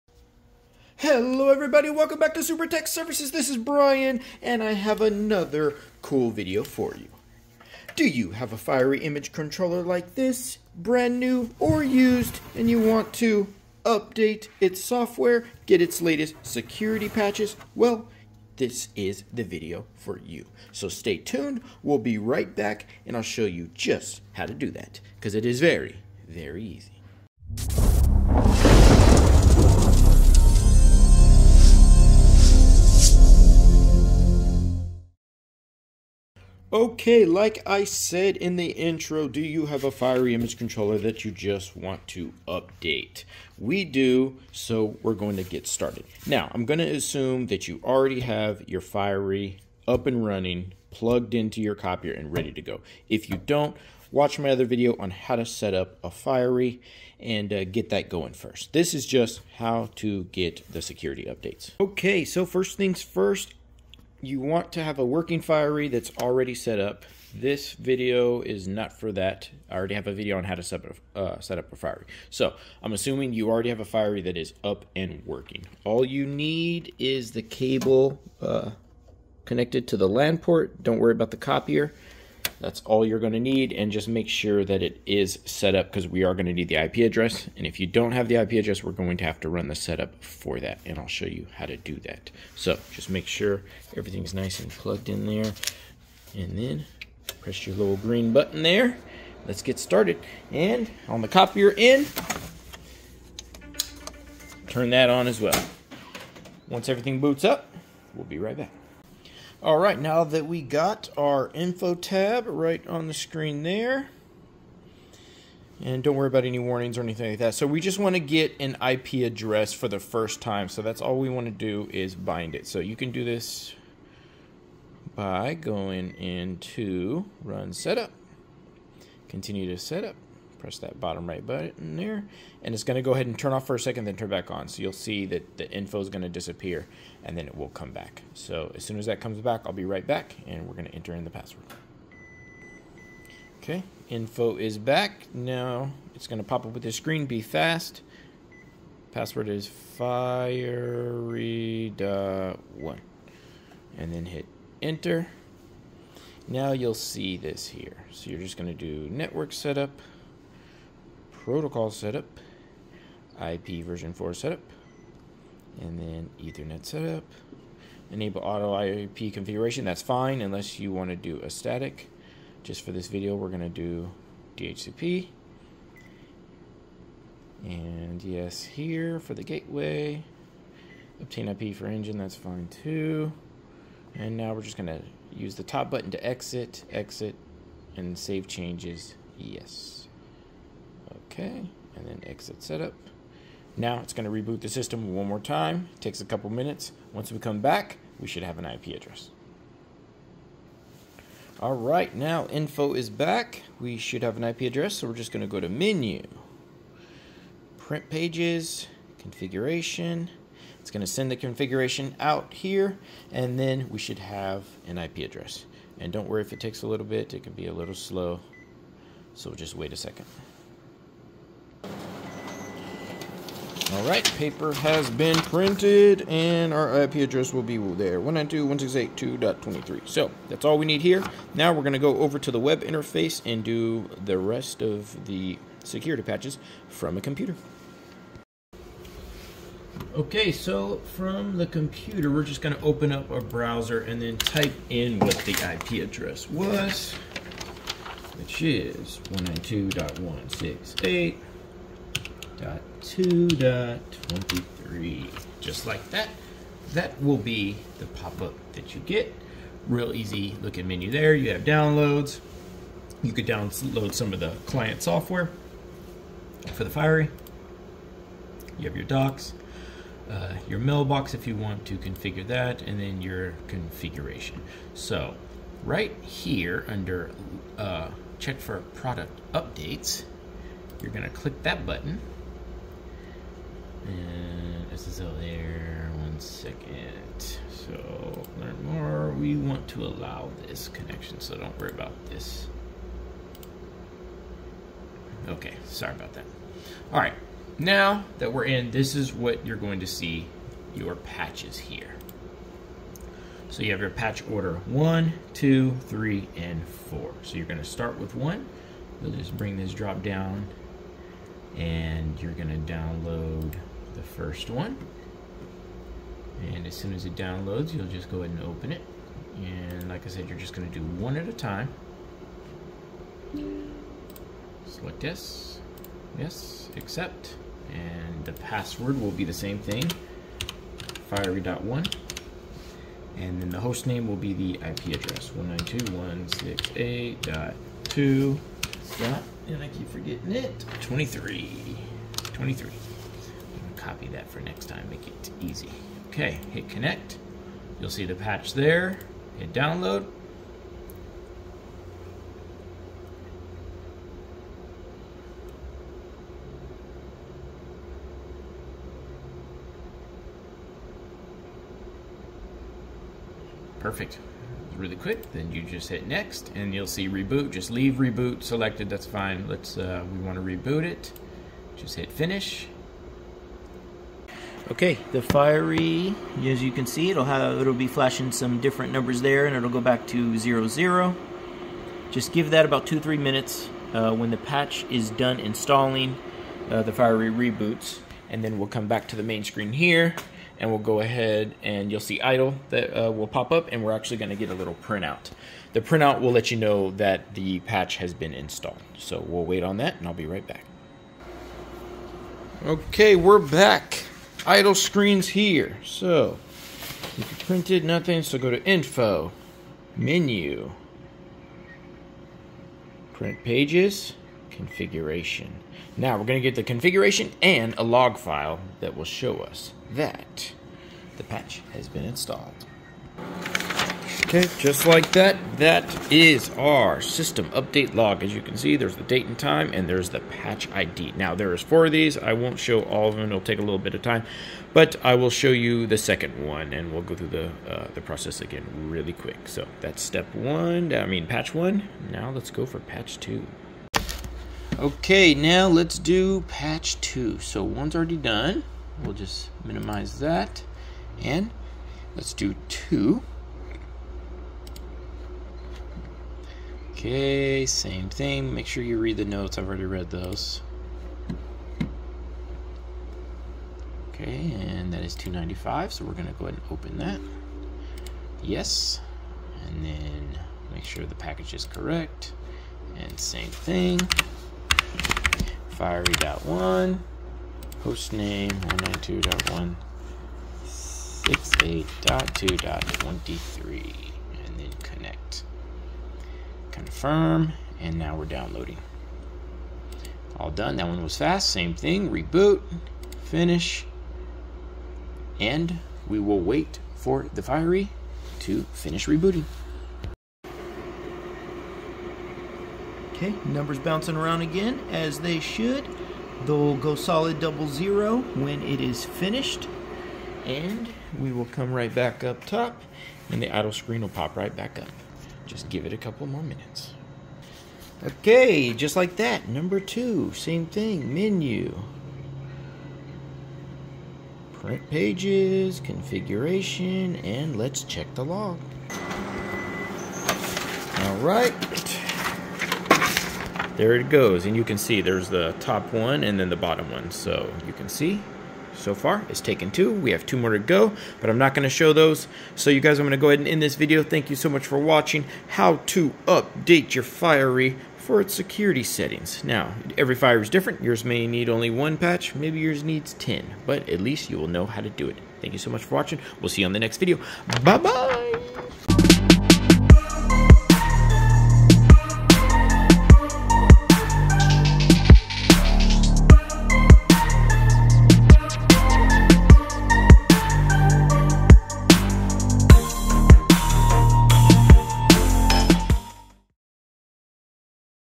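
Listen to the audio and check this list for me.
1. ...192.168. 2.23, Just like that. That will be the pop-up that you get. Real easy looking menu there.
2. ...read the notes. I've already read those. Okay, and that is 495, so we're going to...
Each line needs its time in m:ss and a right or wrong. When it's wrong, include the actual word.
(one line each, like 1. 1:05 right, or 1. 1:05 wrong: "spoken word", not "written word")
1. 4:09 right
2. 7:39 wrong: "295", not "495".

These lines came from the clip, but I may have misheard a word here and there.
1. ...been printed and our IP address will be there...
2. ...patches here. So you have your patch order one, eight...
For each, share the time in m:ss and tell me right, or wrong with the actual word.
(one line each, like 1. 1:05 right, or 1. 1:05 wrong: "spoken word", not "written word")
1. 3:45 right
2. 5:01 wrong: "two", not "eight".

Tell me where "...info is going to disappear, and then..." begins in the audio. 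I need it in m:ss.
2:15.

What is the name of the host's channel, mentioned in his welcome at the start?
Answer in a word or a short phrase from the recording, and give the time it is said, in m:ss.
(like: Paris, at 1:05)
Supertechs Services, at 0:02.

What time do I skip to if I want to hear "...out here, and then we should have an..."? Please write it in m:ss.
3:32.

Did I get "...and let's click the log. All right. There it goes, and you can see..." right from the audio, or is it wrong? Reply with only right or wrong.
wrong.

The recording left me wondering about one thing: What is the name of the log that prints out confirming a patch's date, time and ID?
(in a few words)
System update log.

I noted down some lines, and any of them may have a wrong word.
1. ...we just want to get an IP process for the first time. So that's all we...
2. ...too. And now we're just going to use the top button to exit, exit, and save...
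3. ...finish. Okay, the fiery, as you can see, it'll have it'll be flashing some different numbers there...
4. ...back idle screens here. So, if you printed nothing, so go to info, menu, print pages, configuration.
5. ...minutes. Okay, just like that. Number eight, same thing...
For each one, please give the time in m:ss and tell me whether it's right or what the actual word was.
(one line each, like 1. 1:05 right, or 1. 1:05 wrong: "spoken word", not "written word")
1. 1:57 wrong: "address", not "process"
2. 3:02 right
3. 6:12 right
4. 6:43 right
5. 8:36 wrong: "two", not "eight".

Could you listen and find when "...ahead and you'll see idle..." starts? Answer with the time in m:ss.
6:31.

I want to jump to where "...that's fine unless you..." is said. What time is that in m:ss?
2:49.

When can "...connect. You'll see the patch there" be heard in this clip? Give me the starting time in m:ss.
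5:46.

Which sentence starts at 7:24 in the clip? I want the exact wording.
Okay, now let's do patch two.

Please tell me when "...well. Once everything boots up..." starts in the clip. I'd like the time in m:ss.
1:45.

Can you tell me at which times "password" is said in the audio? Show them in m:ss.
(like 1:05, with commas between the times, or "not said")
2:21, 2:29, 5:28.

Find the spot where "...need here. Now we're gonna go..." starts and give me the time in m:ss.
3:50.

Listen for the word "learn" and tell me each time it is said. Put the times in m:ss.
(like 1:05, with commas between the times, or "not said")
4:48.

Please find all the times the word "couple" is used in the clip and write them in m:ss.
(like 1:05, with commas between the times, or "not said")
3:16, 8:36.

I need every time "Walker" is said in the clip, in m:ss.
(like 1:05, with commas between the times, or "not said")
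not said.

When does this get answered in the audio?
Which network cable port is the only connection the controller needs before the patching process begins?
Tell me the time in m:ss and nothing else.
1:20.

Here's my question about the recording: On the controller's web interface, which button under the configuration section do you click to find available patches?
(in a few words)
Check for product updates.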